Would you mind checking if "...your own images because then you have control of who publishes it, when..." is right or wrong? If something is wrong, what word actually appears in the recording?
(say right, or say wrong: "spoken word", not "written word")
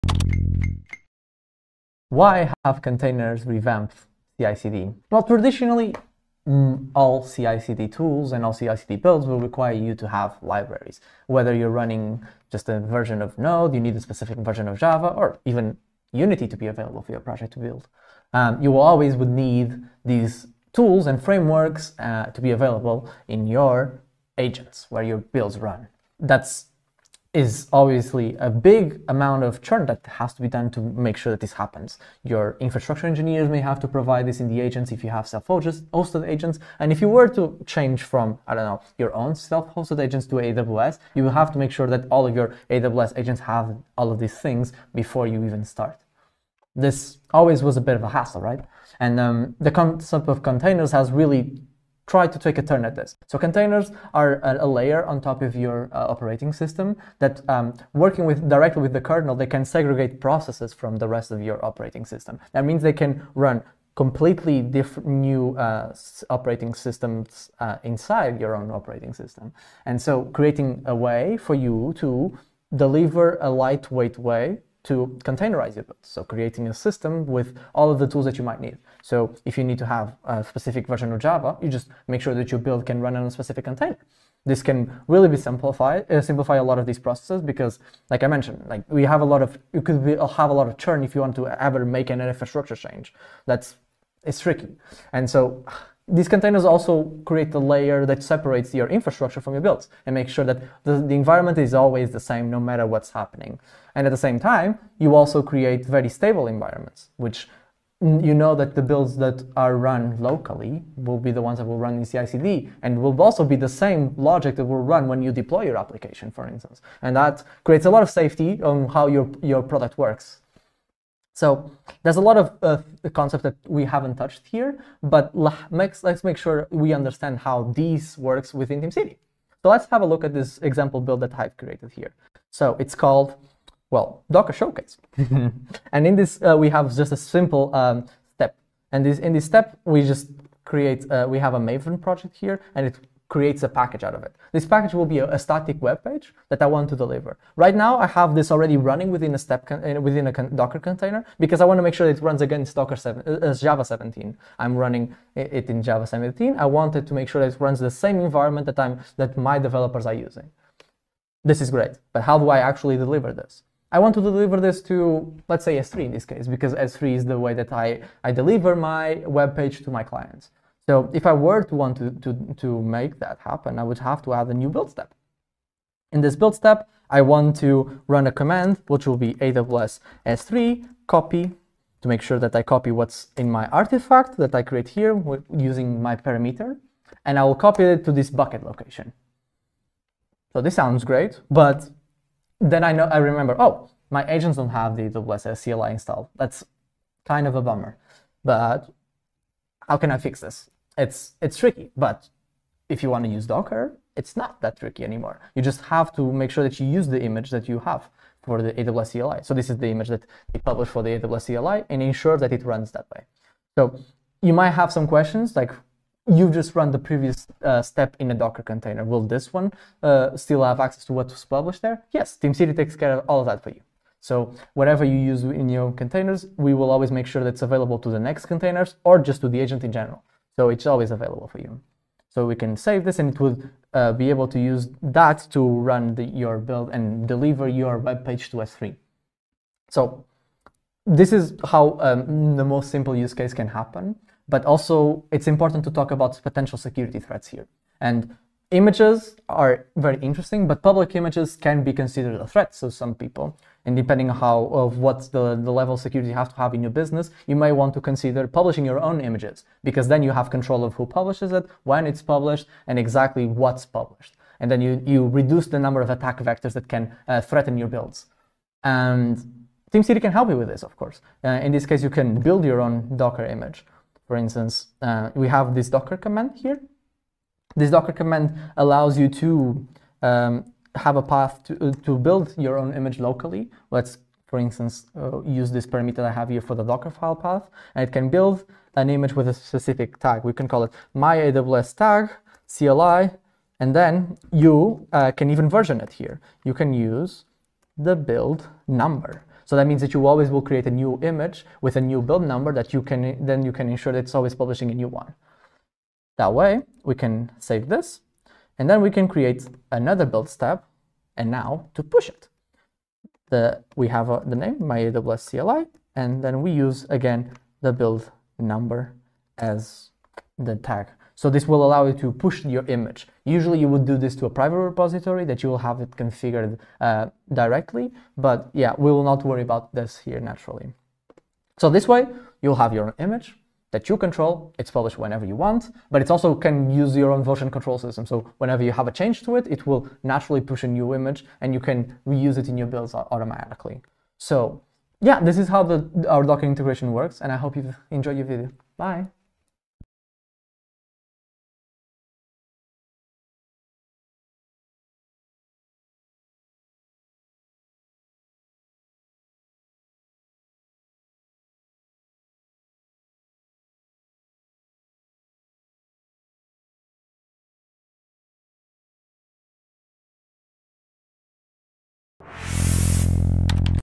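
right.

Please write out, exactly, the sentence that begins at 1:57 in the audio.
And that creates a lot of safety on how your your product works.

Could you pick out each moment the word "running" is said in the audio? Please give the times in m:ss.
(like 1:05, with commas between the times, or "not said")
0:11, 2:28, 2:34.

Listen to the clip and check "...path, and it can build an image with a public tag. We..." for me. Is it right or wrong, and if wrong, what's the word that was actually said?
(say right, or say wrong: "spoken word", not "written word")
wrong: "specific", not "public".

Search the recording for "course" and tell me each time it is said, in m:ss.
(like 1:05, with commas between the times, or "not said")
4:30.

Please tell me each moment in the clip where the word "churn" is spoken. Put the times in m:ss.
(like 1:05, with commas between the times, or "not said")
0:29, 1:30.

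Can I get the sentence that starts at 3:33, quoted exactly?
So you might have some questions like you just run the previous uh, step in a Docker container.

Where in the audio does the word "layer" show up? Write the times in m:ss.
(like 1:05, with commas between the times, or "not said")
0:54, 1:37.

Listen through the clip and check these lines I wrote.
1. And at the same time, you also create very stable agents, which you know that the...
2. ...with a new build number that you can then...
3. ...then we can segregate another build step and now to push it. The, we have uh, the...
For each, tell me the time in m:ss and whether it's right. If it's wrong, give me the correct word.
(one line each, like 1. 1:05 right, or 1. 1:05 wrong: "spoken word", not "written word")
1. 1:43 wrong: "environments", not "agents"
2. 5:01 right
3. 5:08 wrong: "create", not "segregate".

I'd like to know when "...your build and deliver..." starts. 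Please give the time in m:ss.
3:56.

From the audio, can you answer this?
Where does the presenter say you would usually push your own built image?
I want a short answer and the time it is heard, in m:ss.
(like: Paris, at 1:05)
private repository, at 5:24.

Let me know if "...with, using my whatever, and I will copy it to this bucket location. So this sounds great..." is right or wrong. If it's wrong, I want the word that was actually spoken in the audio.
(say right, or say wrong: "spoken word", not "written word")
wrong: "parameter", not "whatever".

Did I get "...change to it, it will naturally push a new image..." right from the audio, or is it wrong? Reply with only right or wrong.
right.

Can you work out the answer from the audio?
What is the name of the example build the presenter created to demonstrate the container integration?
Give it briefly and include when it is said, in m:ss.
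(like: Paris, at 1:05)
Docker Showcase, at 2:14.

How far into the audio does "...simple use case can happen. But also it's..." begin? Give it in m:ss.
4:02.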